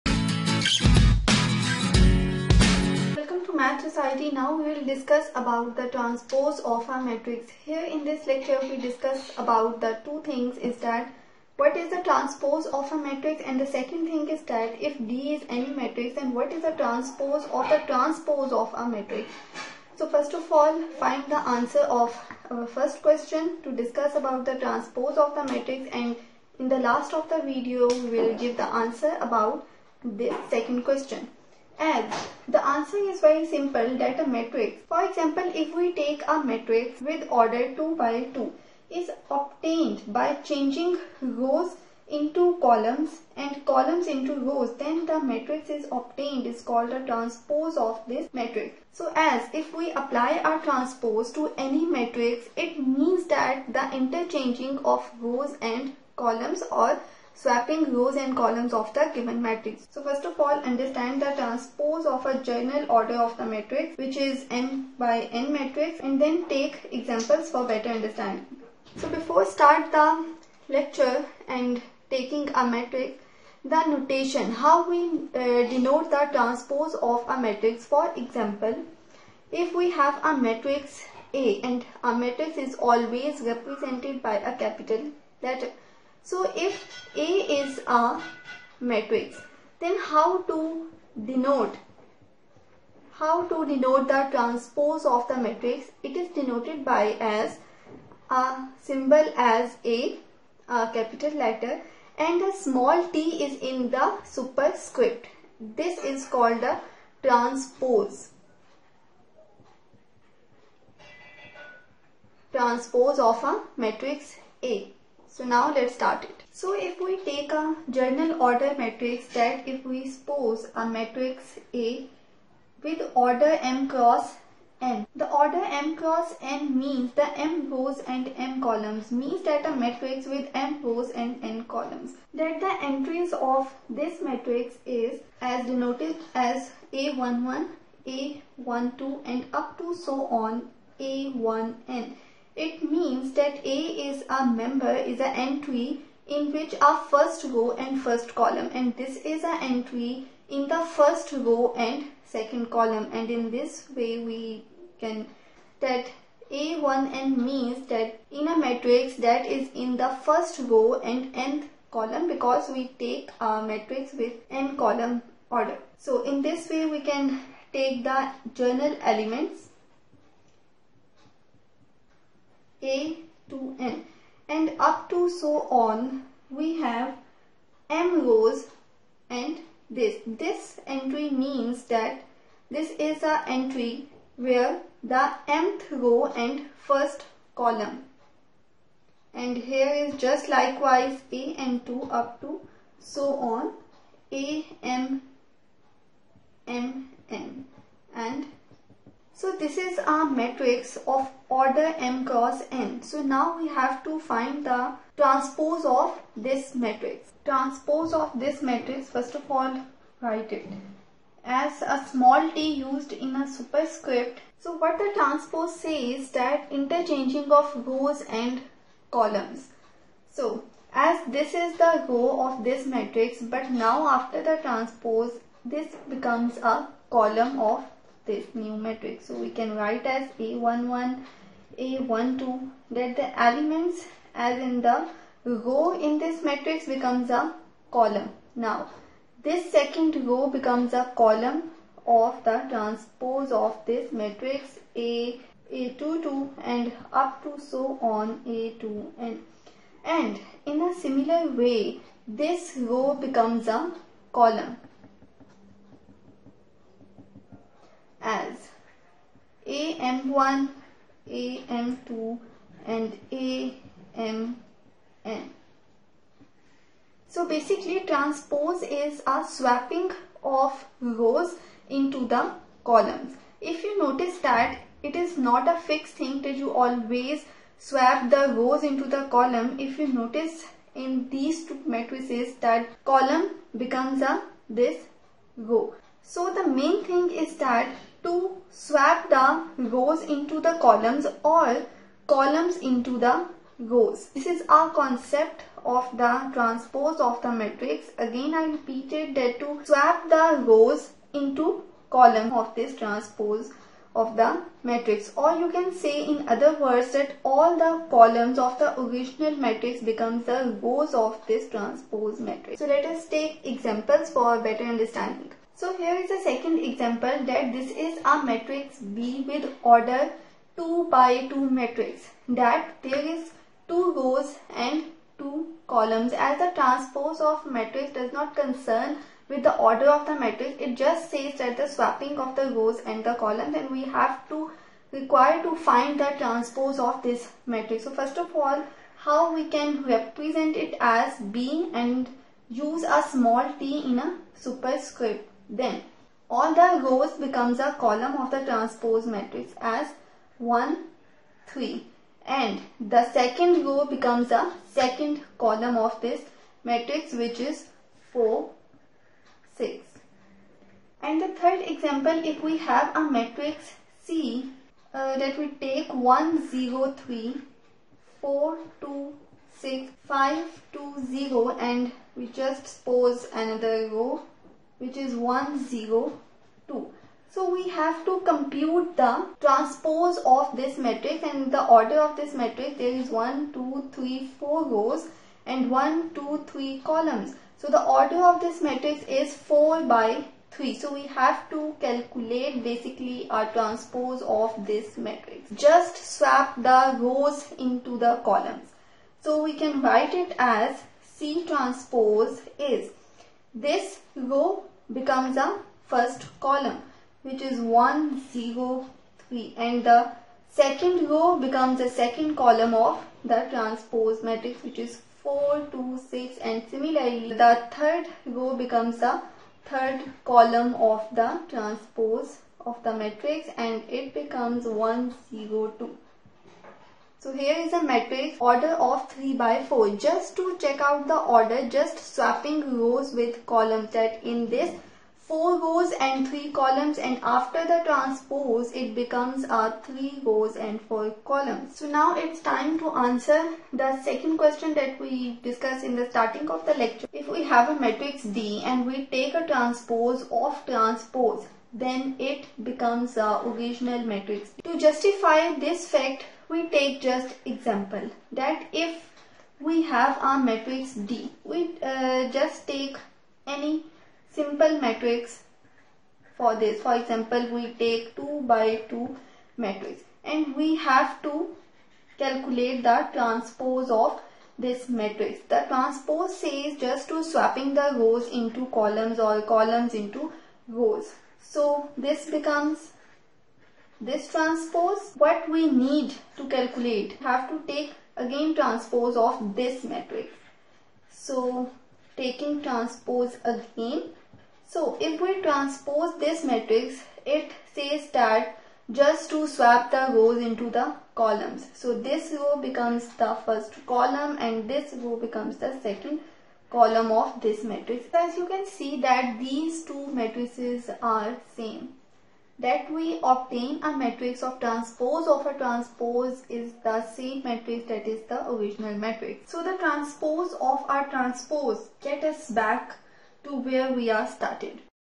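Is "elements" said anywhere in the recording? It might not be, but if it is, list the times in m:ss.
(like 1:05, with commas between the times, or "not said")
2:49, 3:53.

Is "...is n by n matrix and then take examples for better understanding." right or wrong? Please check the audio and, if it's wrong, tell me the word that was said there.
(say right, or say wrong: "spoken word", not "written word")
right.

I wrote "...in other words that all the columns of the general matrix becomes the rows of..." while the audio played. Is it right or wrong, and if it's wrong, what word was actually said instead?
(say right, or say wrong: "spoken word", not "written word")
wrong: "original", not "general".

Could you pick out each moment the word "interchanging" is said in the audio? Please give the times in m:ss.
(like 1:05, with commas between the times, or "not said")
0:53, 3:36.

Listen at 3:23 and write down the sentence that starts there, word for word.
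So now we have to find the transpose of this matrix.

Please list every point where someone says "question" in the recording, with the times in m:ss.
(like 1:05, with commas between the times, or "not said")
0:23, 0:30, 7:24.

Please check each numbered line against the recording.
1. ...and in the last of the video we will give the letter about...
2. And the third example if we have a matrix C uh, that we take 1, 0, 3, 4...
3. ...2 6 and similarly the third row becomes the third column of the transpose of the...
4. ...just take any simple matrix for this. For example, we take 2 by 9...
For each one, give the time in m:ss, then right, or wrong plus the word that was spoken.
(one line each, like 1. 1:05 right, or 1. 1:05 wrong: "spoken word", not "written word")
1. 0:26 wrong: "answer", not "letter"
2. 6:01 right
3. 6:55 right
4. 7:42 wrong: "2", not "9".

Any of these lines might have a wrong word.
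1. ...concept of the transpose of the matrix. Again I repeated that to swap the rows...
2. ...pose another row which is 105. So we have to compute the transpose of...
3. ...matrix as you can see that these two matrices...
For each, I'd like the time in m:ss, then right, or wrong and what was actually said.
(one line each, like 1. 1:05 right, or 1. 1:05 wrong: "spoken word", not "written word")
1. 4:54 right
2. 6:13 wrong: "102", not "105"
3. 8:27 right.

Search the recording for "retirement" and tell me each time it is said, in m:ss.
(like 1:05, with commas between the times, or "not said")
not said.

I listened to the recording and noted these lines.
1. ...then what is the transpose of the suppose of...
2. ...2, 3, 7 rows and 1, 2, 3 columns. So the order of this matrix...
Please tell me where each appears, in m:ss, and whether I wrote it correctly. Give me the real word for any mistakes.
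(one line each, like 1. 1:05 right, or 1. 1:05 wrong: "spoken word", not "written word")
1. 0:16 wrong: "transpose", not "suppose"
2. 6:23 wrong: "4", not "7".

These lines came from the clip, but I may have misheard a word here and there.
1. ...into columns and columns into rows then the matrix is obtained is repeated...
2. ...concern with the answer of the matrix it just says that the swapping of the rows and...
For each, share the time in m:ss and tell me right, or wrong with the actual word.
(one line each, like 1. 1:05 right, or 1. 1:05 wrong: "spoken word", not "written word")
1. 0:42 wrong: "called", not "repeated"
2. 5:28 wrong: "order", not "answer".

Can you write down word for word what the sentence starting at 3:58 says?
Now this second row becomes a column of the transpose of this matrix A, A22 and up to so on A2n.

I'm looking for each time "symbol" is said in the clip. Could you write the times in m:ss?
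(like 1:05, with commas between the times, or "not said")
1:38.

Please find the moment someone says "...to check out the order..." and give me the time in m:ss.
7:10.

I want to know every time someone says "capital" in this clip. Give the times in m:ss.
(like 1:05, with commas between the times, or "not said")
1:24, 1:40.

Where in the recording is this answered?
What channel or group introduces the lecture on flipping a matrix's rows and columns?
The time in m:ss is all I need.
0:03.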